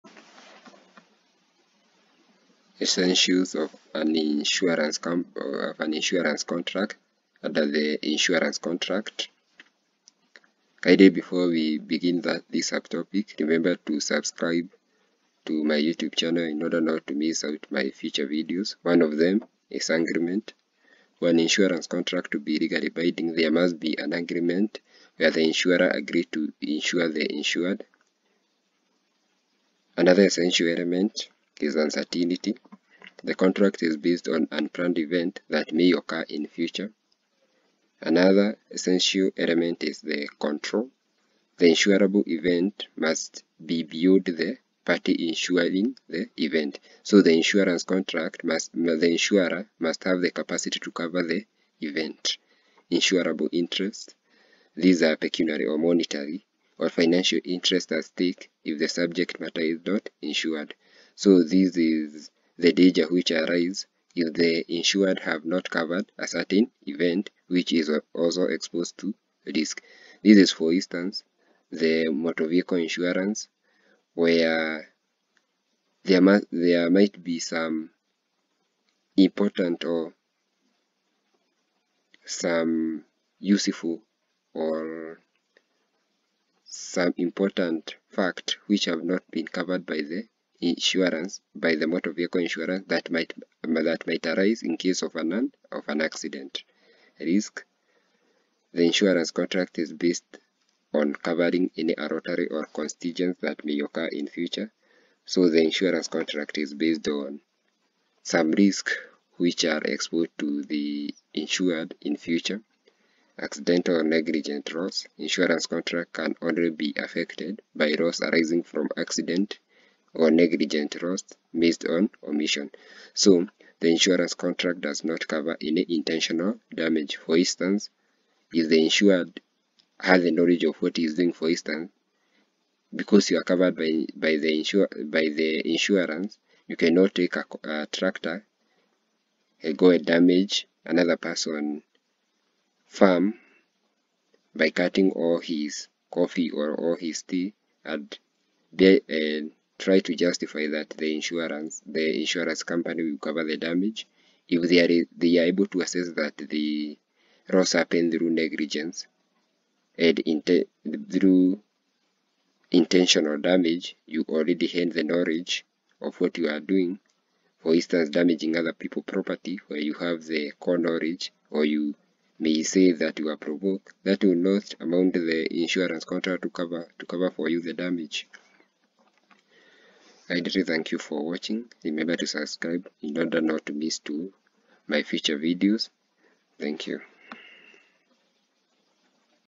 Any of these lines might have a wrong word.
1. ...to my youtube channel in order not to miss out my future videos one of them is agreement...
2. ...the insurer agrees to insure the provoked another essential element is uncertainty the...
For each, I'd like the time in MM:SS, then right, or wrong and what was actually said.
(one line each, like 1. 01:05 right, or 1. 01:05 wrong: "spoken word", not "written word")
1. 00:15 right
2. 00:25 wrong: "insured", not "provoked".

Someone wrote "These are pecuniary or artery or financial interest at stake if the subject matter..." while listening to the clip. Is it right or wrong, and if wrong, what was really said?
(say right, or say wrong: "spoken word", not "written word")
wrong: "monetary", not "artery".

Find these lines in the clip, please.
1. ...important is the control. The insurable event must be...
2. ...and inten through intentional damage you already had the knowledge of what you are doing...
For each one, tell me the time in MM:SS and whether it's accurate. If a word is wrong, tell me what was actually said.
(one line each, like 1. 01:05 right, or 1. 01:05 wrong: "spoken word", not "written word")
1. 00:39 wrong: "element", not "important"
2. 02:40 right.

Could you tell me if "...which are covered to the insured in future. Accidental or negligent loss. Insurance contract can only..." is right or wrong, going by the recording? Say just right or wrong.
wrong.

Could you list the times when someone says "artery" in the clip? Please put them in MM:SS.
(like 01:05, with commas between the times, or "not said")
01:41.